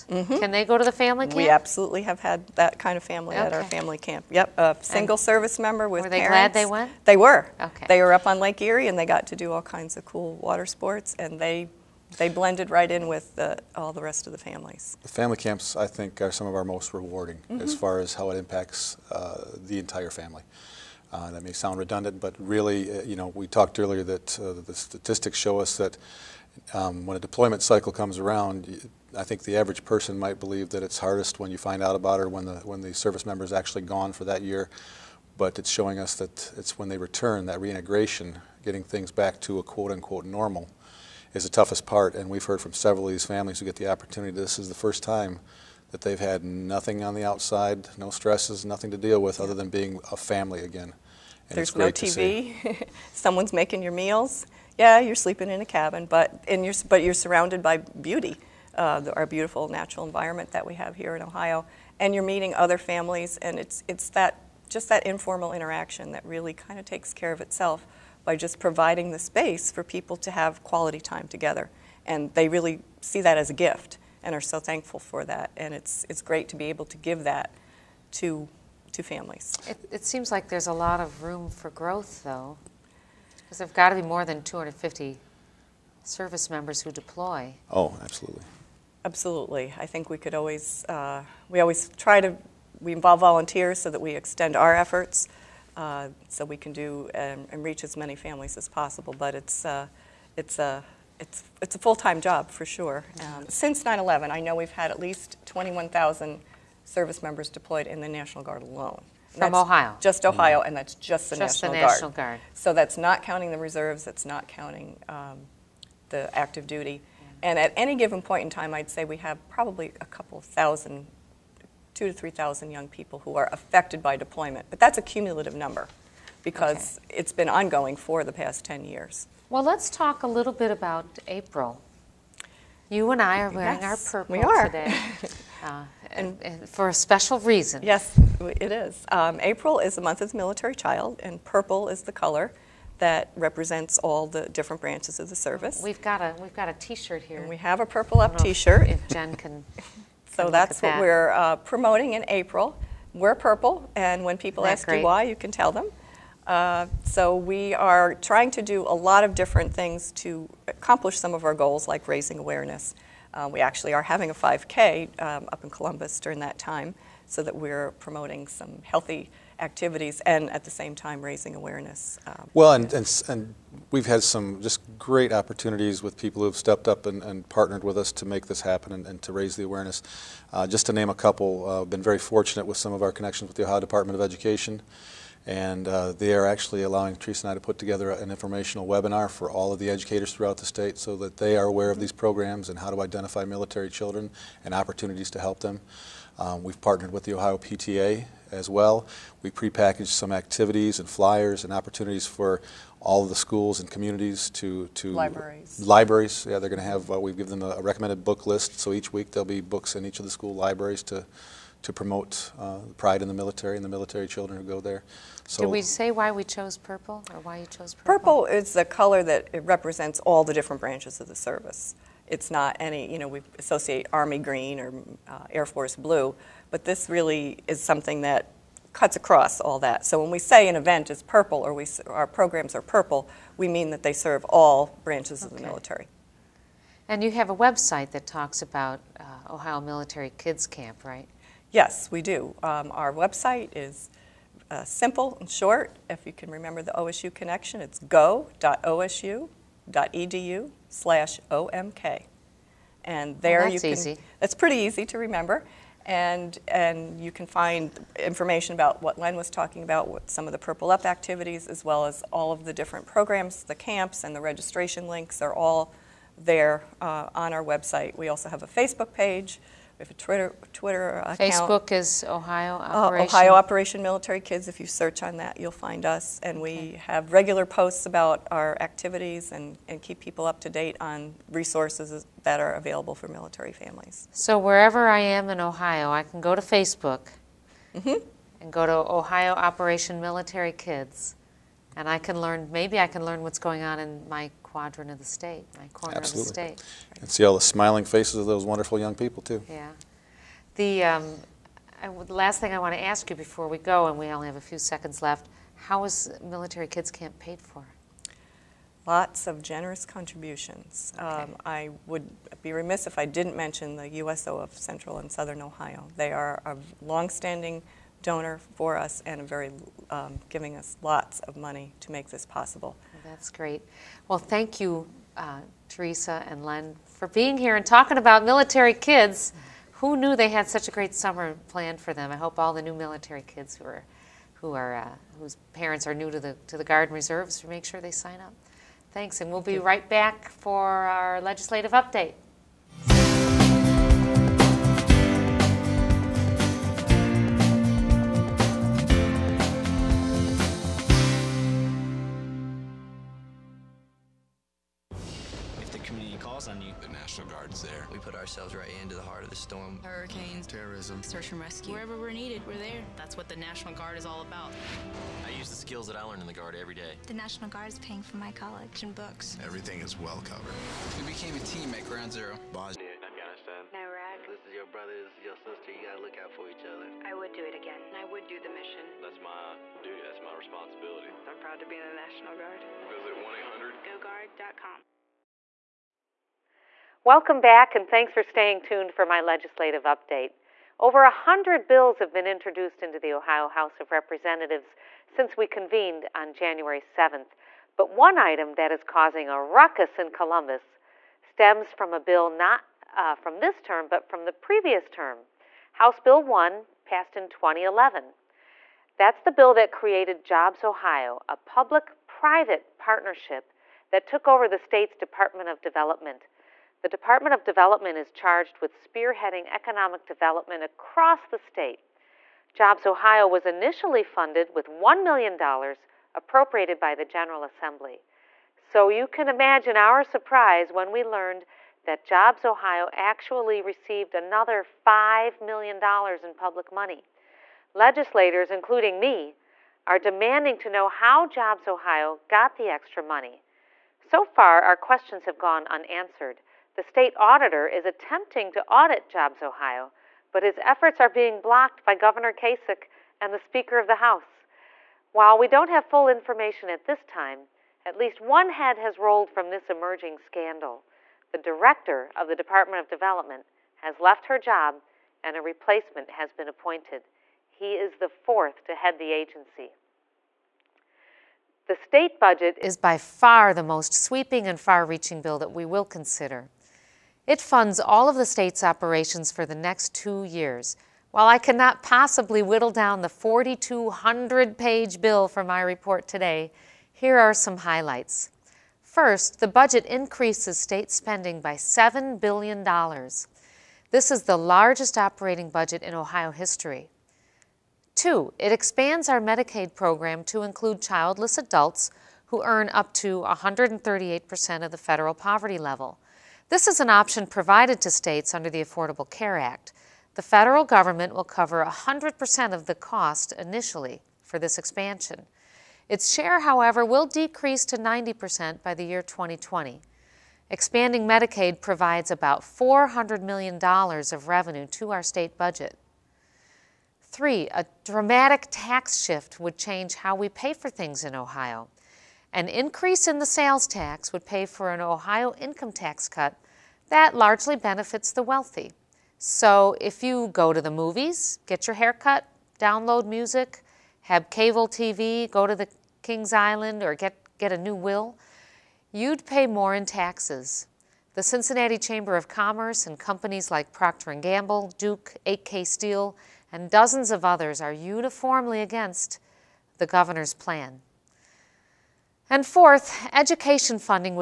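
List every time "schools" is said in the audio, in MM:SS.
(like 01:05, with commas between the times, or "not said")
03:23, 03:30.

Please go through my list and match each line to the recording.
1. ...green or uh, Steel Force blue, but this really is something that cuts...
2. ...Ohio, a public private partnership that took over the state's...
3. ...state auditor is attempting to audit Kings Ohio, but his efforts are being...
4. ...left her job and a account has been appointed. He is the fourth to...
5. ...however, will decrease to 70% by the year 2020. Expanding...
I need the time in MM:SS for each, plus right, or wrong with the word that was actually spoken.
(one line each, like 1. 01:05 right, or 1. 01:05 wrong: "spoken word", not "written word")
1. 03:44 wrong: "Air", not "Steel"
2. 06:50 right
3. 07:27 wrong: "Jobs", not "Kings"
4. 07:44 wrong: "replacement", not "account"
5. 08:36 wrong: "90", not "70".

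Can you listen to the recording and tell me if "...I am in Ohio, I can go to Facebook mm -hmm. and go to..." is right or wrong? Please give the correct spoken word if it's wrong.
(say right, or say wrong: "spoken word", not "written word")
right.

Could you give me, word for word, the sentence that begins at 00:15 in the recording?
The family camps, I think, are some of our most rewarding mm-hmm.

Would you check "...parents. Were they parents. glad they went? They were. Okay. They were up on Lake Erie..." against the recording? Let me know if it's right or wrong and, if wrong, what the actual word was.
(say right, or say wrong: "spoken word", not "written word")
right.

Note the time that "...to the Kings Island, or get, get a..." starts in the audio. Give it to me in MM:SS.
09:05.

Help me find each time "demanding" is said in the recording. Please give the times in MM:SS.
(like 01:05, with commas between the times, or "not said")
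07:20.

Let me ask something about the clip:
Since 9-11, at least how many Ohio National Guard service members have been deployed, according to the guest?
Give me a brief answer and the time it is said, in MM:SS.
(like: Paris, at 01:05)
21,000, at 01:45.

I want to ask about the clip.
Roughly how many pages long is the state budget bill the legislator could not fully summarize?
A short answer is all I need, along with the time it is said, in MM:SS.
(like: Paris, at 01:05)
4,200, at 08:03.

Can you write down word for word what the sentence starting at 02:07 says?
it's been ongoing for the past 10 years.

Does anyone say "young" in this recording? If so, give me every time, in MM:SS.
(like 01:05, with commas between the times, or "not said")
02:02, 04:58.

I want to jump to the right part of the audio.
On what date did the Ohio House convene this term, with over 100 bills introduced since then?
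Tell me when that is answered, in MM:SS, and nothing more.
06:36.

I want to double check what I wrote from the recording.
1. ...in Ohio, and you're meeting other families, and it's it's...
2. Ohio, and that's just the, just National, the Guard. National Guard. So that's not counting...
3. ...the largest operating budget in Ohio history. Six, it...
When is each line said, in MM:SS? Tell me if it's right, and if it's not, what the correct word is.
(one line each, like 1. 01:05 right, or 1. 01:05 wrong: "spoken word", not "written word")
1. 01:01 right
2. 01:50 right
3. 08:14 wrong: "Two", not "Six".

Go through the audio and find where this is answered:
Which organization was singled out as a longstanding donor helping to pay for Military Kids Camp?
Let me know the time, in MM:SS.
05:14.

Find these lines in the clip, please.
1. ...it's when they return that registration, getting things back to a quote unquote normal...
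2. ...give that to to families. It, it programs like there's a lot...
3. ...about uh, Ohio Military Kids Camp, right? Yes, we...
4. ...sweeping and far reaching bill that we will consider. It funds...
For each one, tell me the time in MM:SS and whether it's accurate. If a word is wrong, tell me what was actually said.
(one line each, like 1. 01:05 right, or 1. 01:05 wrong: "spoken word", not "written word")
1. 00:36 wrong: "reintegration", not "registration"
2. 01:16 wrong: "seems", not "programs"
3. 03:58 right
4. 07:54 right.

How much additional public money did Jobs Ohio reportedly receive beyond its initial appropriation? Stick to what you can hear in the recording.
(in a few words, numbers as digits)
$5 million.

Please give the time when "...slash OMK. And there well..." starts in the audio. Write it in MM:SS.
04:10.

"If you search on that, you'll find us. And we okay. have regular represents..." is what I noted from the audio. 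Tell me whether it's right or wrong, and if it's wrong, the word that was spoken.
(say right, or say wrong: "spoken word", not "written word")
wrong: "posts", not "represents".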